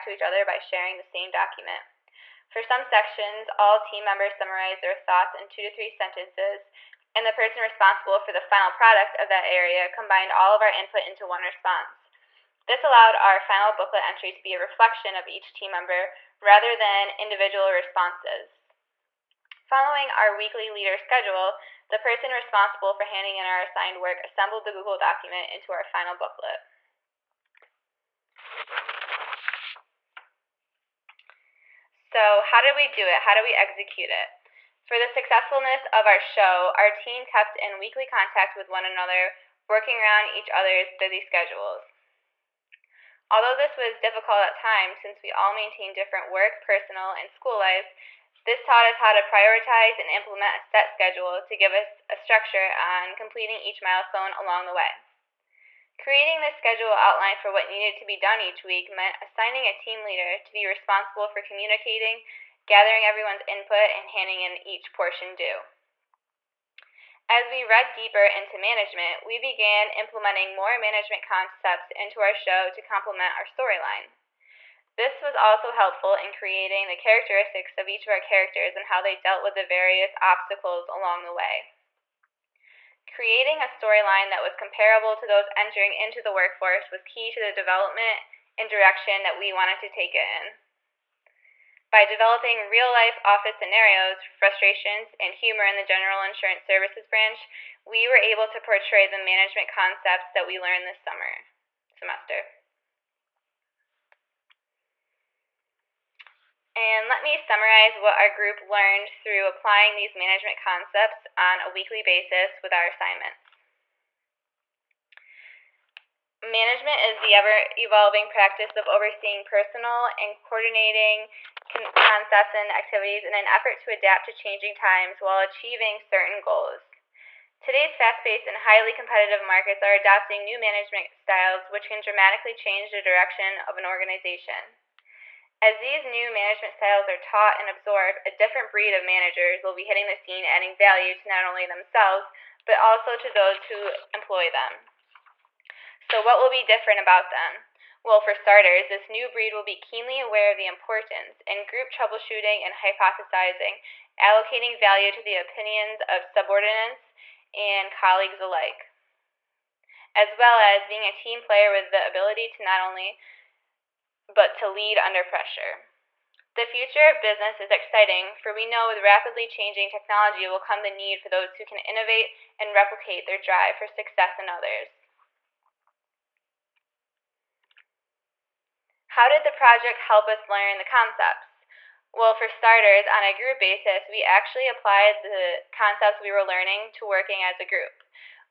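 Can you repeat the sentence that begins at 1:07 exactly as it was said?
As we read deeper into management, we began implementing more management concepts into our show to complement our storyline.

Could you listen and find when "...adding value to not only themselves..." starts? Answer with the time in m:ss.
2:20.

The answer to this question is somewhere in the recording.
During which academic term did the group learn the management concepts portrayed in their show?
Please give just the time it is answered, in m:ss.
1:40.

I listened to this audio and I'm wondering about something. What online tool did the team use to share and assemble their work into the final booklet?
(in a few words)
Google document.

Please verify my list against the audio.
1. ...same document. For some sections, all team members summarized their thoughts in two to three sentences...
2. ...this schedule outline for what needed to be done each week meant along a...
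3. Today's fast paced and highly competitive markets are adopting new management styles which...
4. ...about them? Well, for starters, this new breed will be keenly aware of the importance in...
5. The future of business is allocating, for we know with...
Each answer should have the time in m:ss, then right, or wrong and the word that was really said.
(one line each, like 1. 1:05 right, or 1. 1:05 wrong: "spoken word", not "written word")
1. 0:01 right
2. 0:56 wrong: "assigning", not "along"
3. 2:07 right
4. 2:26 right
5. 2:46 wrong: "exciting", not "allocating".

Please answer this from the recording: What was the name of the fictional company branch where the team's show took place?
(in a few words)
General Insurance Services.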